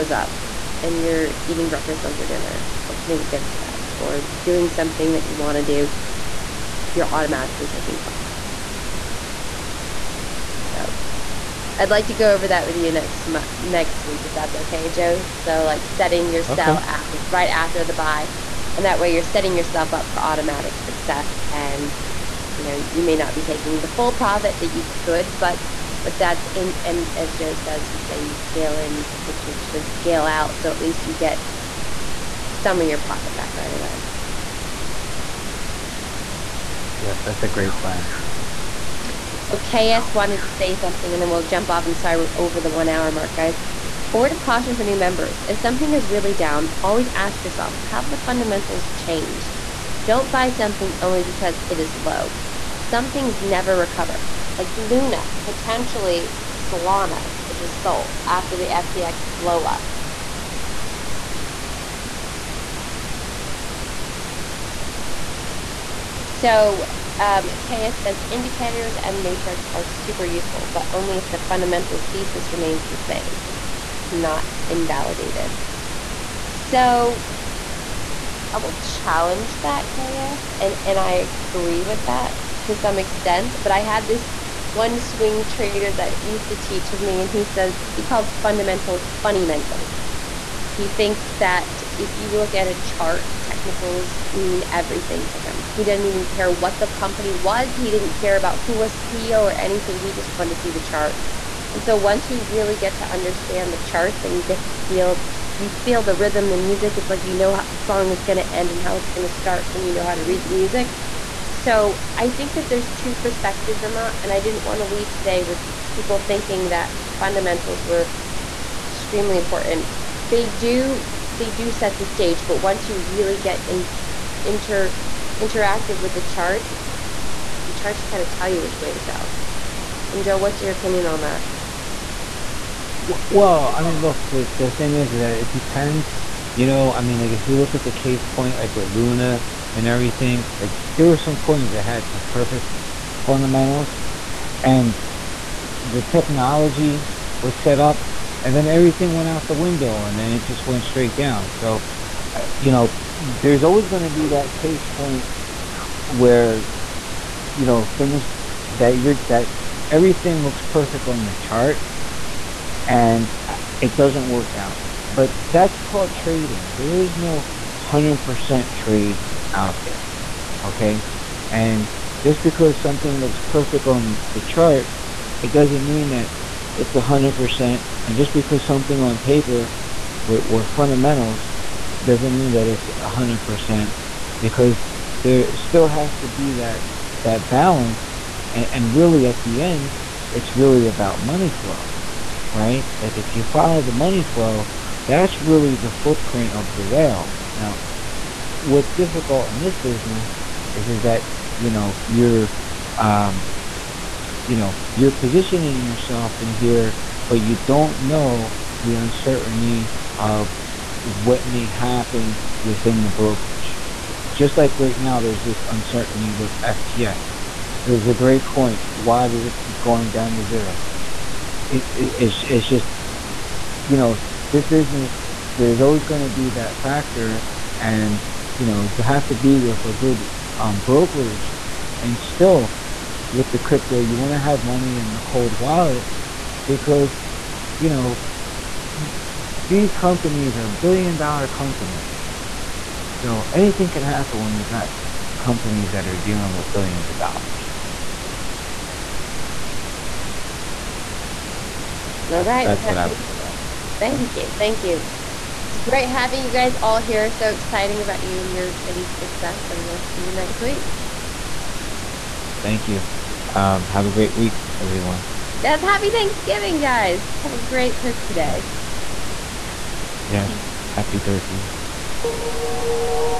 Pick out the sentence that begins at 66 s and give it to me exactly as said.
So um, KS says indicators and matrix are super useful, but only if the fundamental thesis remains the same not invalidated.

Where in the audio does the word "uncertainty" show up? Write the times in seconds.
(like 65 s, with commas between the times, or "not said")
208 s, 215 s.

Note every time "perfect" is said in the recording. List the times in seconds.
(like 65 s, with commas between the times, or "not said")
142 s, 160 s, 173 s.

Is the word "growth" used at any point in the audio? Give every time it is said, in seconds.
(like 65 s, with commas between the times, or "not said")
not said.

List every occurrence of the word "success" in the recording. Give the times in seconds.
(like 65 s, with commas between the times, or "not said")
20 s, 259 s.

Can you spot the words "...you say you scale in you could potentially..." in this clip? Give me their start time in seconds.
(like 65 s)
27 s.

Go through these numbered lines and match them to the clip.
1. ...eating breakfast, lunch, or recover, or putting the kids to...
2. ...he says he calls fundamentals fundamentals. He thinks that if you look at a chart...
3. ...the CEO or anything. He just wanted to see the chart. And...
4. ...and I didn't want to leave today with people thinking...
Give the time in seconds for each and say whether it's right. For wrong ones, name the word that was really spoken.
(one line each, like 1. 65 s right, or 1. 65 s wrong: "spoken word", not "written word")
1. 1 s wrong: "dinner", not "recover"
2. 87 s right
3. 98 s right
4. 114 s right.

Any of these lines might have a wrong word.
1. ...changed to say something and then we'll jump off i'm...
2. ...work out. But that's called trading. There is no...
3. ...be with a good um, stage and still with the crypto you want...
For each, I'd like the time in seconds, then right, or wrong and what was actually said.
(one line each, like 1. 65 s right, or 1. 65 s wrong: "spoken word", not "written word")
1. 40 s wrong: "wanted", not "changed"
2. 164 s right
3. 229 s wrong: "brokerage", not "stage".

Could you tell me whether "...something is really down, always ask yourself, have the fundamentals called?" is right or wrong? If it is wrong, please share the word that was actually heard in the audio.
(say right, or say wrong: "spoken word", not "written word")
wrong: "changed", not "called".